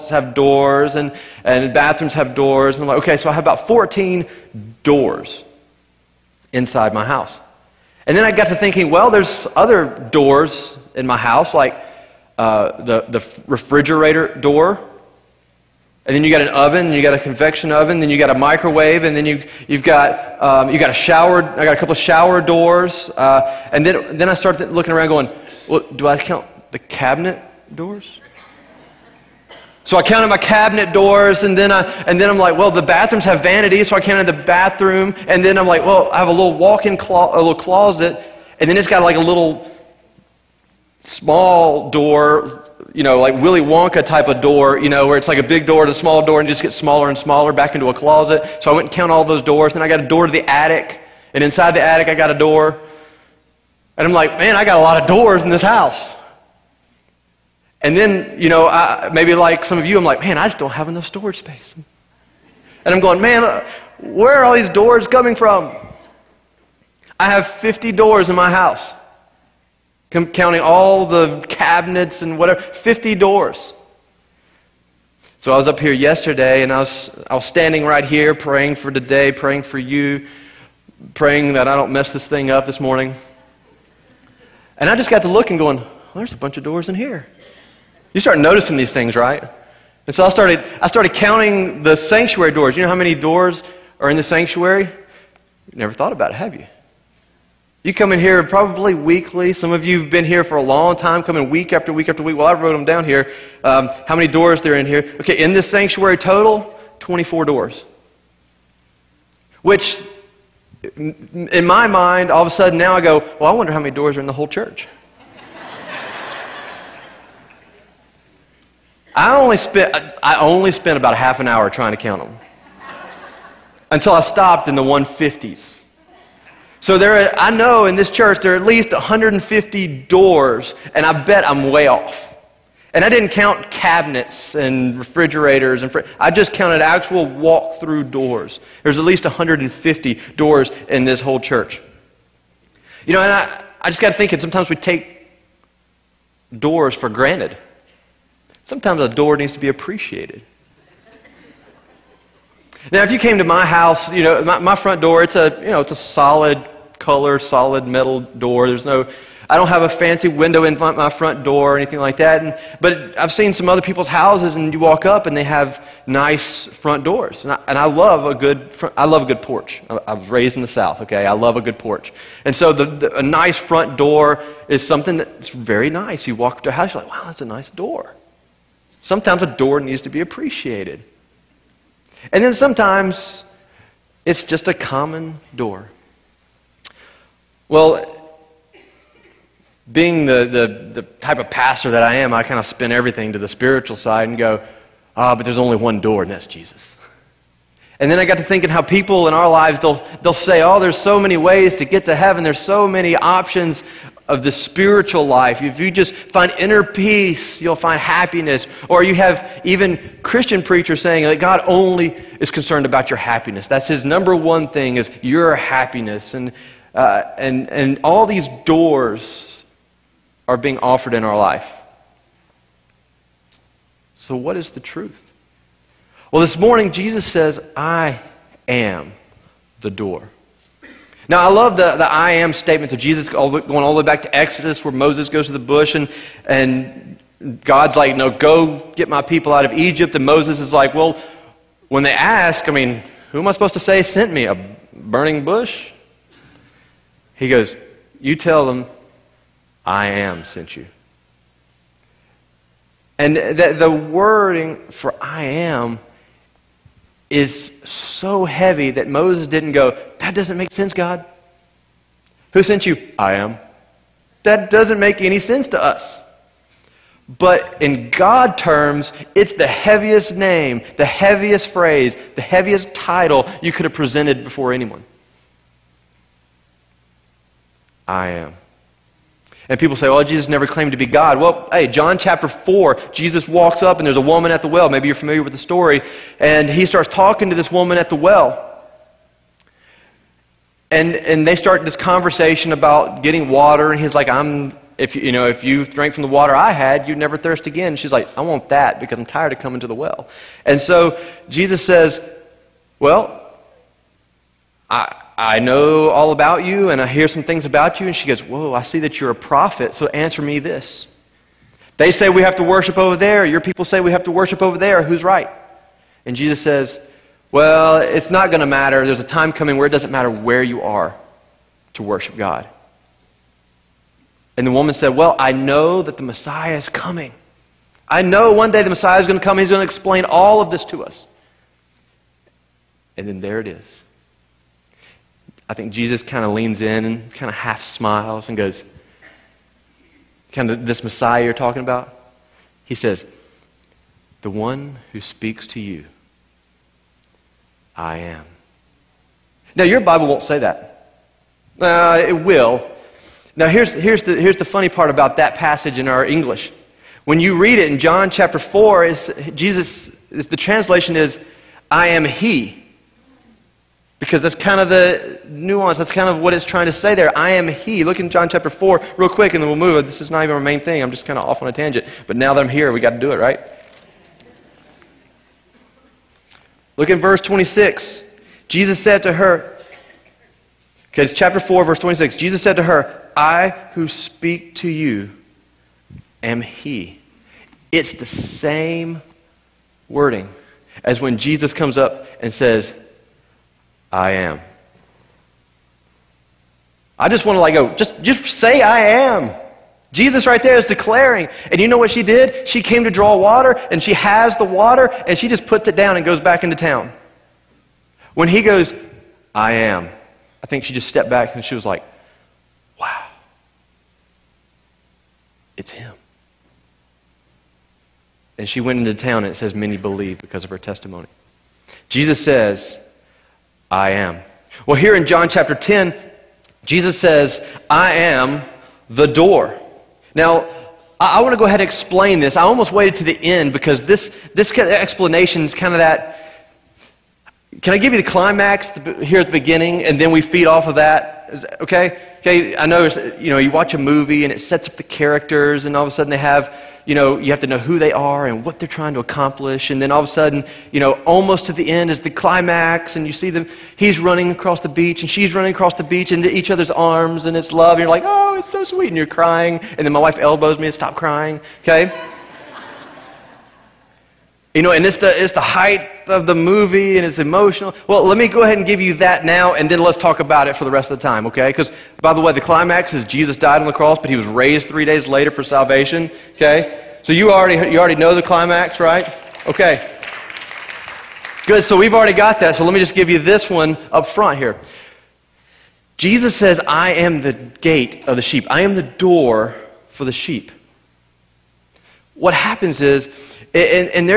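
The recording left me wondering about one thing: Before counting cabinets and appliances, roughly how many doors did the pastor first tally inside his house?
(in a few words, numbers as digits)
14.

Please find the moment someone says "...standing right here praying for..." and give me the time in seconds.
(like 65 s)
77 s.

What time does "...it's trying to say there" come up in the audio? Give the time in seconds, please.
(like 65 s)
366 s.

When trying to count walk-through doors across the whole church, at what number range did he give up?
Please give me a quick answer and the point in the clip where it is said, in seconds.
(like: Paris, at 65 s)
the 150s, at 124 s.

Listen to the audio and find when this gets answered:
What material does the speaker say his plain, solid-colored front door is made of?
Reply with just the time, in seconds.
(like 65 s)
157 s.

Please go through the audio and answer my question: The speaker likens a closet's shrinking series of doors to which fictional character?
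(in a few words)
Willy Wonka.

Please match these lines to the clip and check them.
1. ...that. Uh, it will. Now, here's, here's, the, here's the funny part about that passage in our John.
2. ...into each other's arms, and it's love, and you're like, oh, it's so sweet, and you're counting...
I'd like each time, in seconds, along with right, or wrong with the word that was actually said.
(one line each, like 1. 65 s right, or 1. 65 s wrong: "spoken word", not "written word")
1. 350 s wrong: "English", not "John"
2. 456 s wrong: "crying", not "counting".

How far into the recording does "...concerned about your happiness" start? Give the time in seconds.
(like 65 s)
212 s.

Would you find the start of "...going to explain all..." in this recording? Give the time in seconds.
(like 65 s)
329 s.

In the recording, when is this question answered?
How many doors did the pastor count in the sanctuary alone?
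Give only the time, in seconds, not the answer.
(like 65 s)
106 s.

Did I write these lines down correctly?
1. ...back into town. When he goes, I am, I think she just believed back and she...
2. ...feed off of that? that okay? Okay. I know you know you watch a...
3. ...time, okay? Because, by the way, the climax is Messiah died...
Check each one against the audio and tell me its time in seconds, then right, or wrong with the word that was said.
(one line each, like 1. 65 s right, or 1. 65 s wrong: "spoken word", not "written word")
1. 406 s wrong: "stepped", not "believed"
2. 440 s right
3. 471 s wrong: "Jesus", not "Messiah".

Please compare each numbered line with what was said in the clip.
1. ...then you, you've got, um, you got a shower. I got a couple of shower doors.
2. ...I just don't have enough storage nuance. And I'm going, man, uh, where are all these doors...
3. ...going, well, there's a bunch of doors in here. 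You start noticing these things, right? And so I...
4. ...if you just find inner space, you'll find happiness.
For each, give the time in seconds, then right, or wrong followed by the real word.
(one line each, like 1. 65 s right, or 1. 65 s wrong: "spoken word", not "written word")
1. 19 s right
2. 60 s wrong: "space", not "nuance"
3. 85 s right
4. 205 s wrong: "peace", not "space".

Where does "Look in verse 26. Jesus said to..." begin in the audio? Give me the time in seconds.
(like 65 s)
376 s.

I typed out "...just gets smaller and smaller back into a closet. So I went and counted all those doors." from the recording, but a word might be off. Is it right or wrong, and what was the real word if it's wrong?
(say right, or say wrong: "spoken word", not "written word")
right.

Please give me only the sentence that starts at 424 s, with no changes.
Well, here in John chapter 10, Jesus says, I am the door.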